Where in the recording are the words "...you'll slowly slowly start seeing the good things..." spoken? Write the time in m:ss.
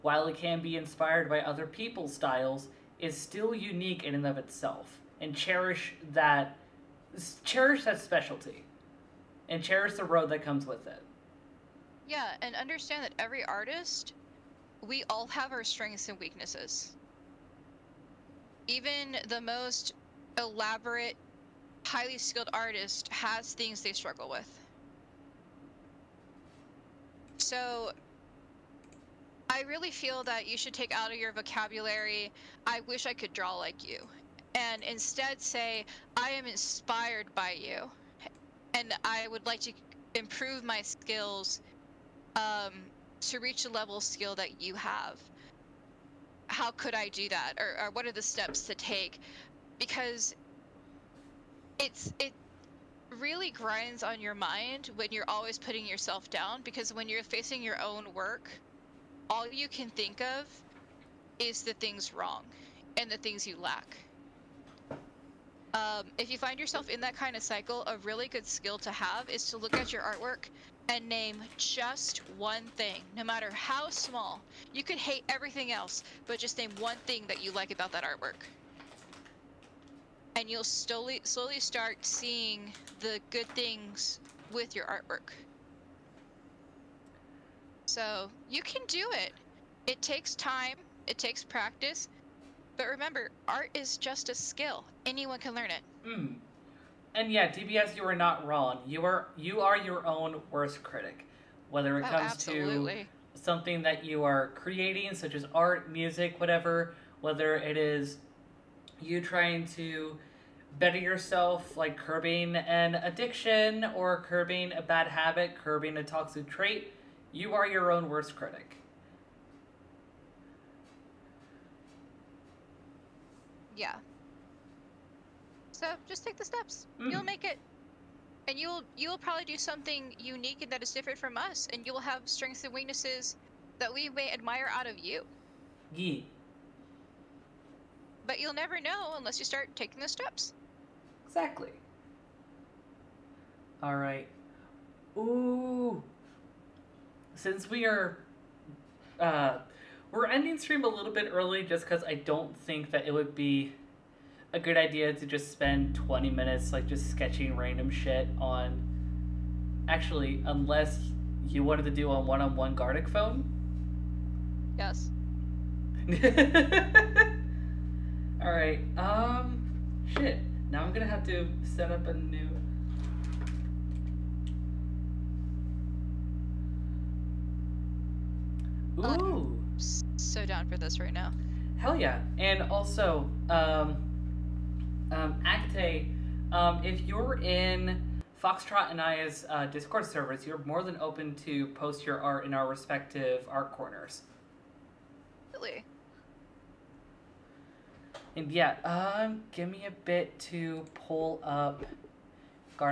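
1:20.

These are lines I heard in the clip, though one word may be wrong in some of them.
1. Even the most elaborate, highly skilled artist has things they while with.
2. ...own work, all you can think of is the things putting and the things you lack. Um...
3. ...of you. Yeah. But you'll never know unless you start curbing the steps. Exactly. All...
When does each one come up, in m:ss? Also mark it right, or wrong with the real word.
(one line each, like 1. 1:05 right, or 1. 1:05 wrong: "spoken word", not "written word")
1. 0:18 wrong: "struggle", not "while"
2. 0:57 wrong: "wrong", not "putting"
3. 2:14 wrong: "taking", not "curbing".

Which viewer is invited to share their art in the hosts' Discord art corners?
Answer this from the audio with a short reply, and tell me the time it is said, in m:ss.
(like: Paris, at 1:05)
Akate, at 3:05.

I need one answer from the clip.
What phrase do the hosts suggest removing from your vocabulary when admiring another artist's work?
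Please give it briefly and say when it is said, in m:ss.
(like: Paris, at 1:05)
I wish I could draw like you, at 0:32.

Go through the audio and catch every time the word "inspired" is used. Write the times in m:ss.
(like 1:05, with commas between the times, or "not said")
0:00, 0:36.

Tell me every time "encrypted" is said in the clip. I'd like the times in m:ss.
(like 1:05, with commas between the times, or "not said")
not said.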